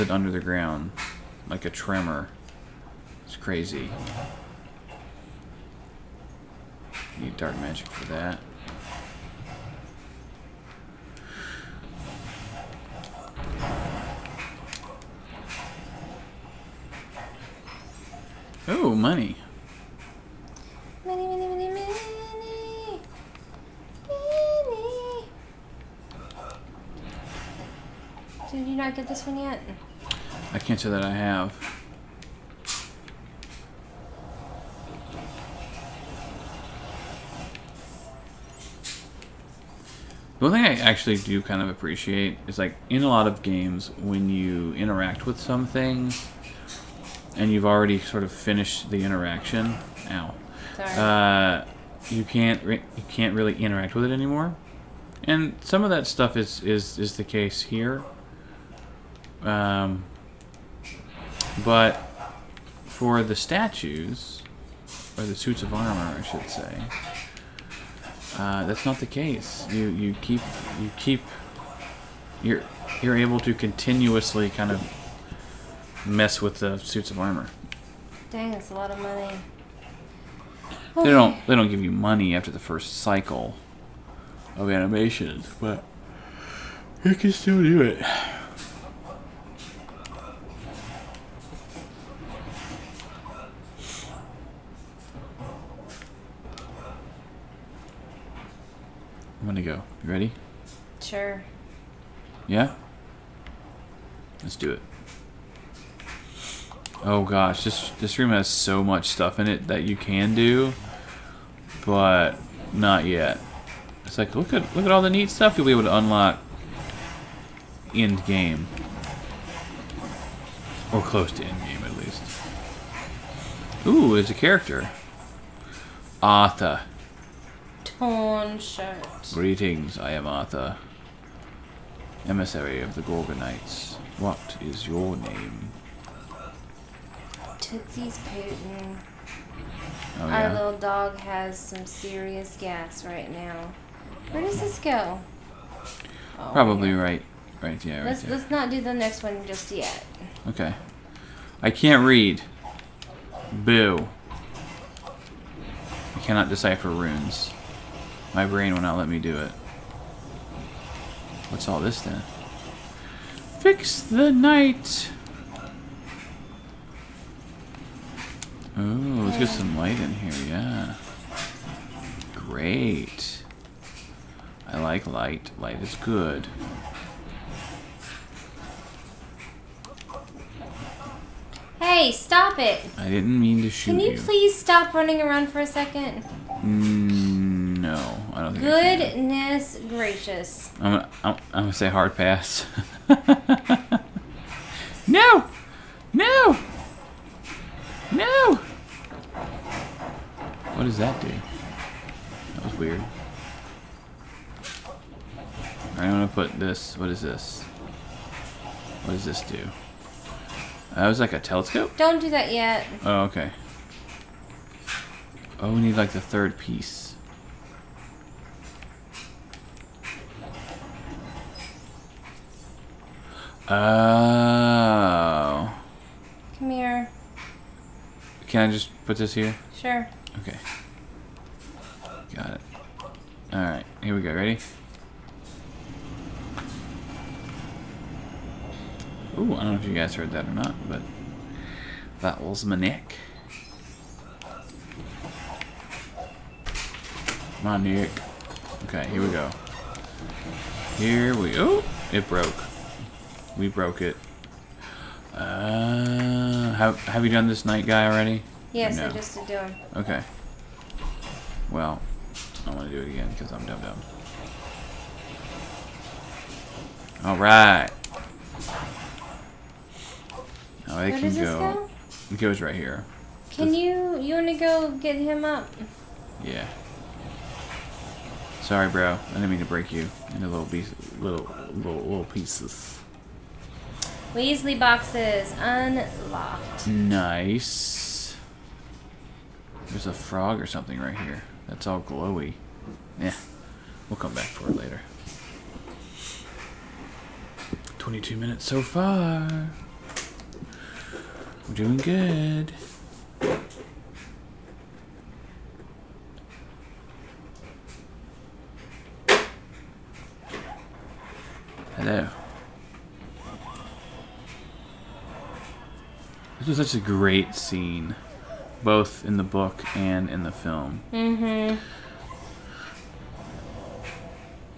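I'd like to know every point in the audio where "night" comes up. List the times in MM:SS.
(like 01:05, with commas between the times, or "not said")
02:44, 04:17.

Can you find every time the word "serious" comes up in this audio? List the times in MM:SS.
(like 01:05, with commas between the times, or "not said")
02:21.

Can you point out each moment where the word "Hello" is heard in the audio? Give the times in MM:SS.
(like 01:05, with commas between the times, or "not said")
05:11.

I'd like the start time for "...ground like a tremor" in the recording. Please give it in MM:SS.
00:00.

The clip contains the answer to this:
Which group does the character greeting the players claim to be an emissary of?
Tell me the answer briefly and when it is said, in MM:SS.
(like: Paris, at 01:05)
the Gorgonites, at 02:13.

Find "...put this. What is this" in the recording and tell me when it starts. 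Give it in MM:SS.
03:26.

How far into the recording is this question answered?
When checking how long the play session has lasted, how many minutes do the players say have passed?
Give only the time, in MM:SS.
04:57.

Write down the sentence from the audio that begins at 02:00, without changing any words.
Or close to end game at least.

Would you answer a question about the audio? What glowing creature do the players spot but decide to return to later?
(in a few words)
frog.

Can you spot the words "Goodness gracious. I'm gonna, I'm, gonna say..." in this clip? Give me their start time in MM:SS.
03:08.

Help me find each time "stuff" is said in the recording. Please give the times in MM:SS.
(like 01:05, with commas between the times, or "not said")
00:56, 01:49, 01:55.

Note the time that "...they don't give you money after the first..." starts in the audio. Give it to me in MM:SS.
01:21.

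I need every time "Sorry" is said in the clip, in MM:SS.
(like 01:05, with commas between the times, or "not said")
00:50, 04:38.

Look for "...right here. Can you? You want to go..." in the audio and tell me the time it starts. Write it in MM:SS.
04:32.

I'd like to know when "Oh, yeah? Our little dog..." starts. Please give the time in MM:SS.
02:20.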